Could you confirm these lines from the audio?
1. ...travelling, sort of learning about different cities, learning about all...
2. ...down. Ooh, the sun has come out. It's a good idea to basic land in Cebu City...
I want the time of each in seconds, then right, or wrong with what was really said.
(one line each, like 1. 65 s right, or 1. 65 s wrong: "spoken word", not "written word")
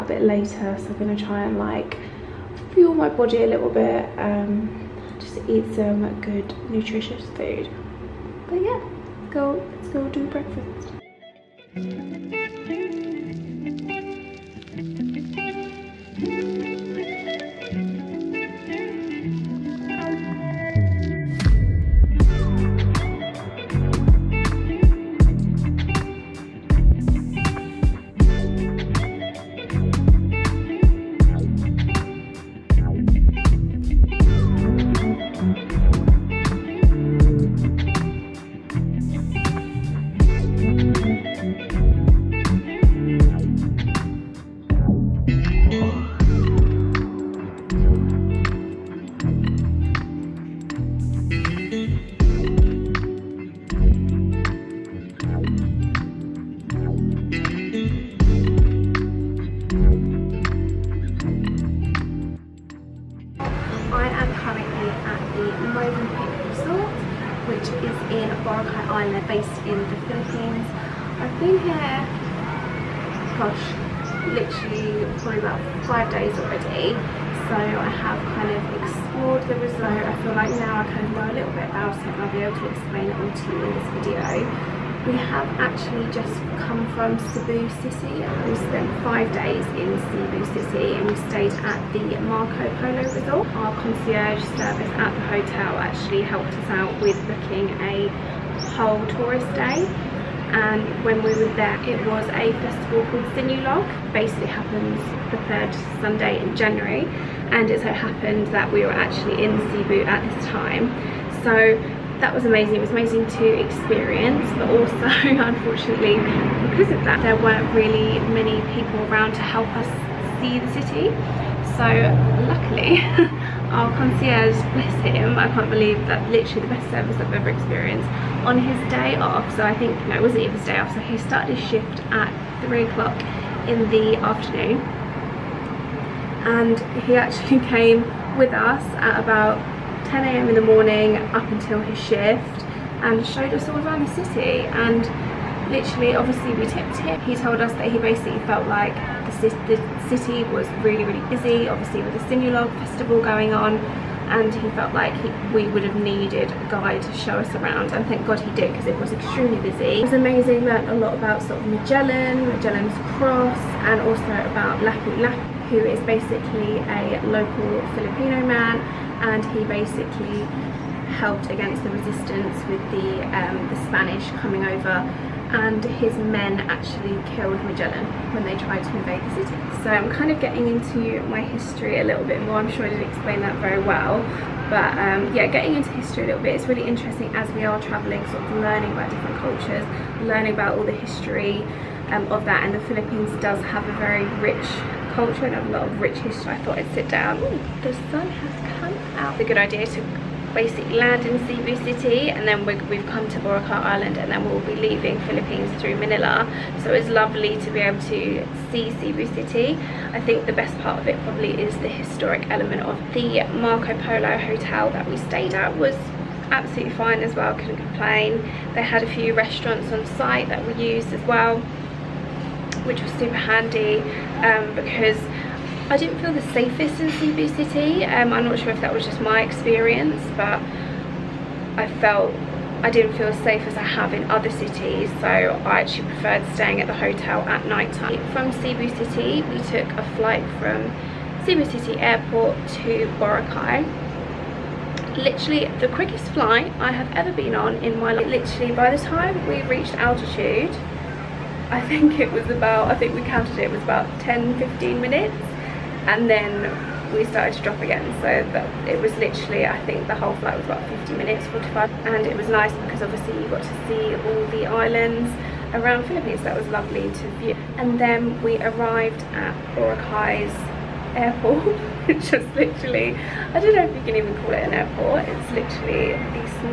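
1. 187 s wrong: "cultures", not "cities"
2. 197 s right.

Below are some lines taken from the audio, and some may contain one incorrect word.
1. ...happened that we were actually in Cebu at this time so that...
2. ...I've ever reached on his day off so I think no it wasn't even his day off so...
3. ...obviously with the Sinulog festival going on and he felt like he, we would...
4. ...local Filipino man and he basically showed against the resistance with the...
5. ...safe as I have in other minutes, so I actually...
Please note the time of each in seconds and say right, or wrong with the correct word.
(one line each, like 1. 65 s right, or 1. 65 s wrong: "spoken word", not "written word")
1. 107 s right
2. 127 s wrong: "experienced", not "reached"
3. 151 s right
4. 167 s wrong: "helped", not "showed"
5. 233 s wrong: "cities", not "minutes".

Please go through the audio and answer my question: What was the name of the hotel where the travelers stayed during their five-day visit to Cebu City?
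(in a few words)
Marco Polo Resort.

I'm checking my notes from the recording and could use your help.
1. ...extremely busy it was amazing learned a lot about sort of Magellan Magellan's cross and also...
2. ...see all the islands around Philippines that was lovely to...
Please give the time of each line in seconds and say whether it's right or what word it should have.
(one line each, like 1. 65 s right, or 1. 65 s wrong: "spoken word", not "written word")
1. 159 s right
2. 263 s right.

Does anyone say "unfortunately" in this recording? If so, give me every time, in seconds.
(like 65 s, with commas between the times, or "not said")
115 s.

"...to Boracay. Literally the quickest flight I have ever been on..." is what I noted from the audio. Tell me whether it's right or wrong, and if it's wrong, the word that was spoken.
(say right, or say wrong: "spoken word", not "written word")
right.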